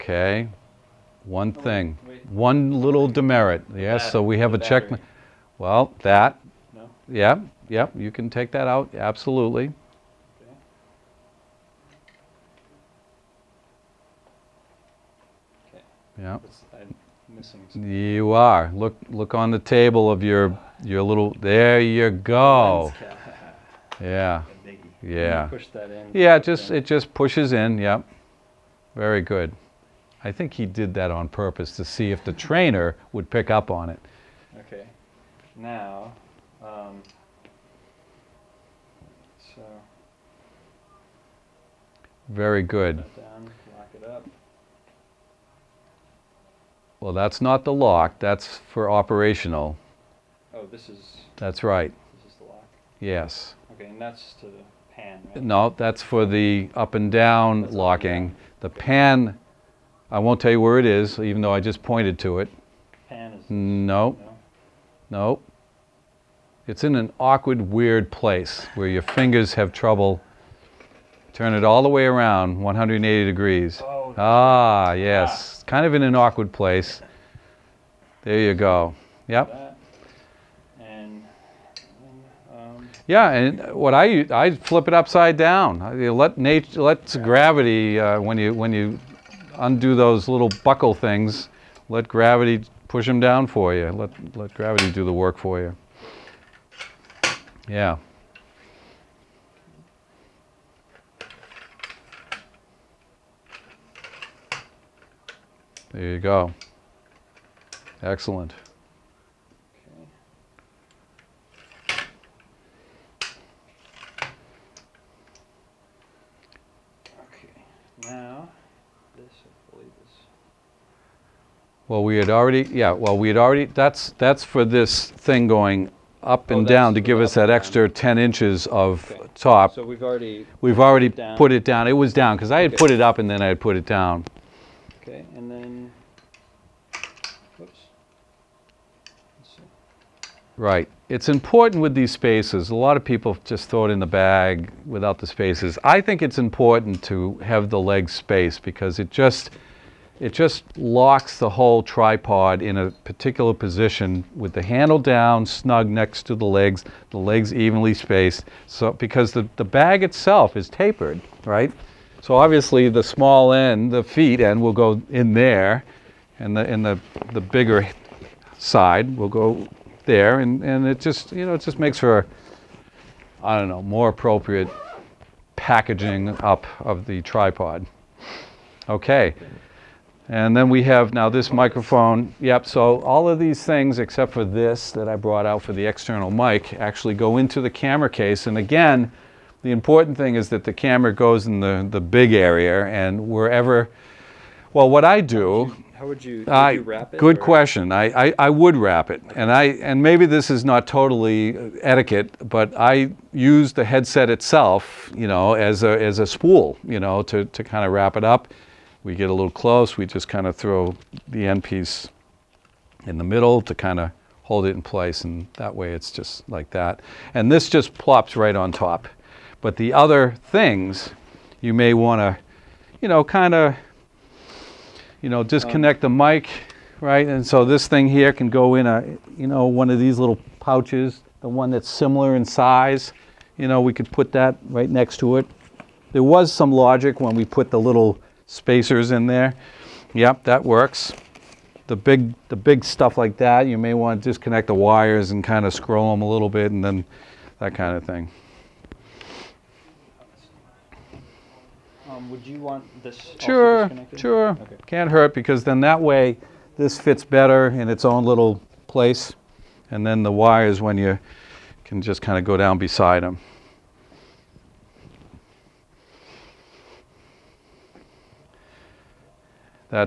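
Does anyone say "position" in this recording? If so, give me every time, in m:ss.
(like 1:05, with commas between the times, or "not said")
2:33.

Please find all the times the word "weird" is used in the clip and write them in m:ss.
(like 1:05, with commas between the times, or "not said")
1:07.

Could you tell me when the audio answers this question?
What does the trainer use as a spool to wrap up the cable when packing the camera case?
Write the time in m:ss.
3:23.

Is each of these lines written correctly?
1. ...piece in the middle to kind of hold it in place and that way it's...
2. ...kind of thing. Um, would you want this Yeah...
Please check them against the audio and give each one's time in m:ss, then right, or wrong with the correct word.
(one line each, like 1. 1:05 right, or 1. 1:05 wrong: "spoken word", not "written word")
1. 3:31 right
2. 4:07 wrong: "Sure", not "Yeah".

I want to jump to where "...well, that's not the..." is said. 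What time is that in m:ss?
0:47.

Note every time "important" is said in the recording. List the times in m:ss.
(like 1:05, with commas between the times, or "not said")
2:21, 2:26, 3:09.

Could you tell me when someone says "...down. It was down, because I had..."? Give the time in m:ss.
2:11.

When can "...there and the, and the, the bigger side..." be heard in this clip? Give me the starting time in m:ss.
2:45.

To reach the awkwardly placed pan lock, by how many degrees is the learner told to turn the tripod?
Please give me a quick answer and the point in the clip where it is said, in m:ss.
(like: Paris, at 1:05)
180 degrees, at 1:12.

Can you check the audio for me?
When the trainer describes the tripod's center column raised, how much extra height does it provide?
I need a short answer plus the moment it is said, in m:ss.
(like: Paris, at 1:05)
10 inches, at 2:07.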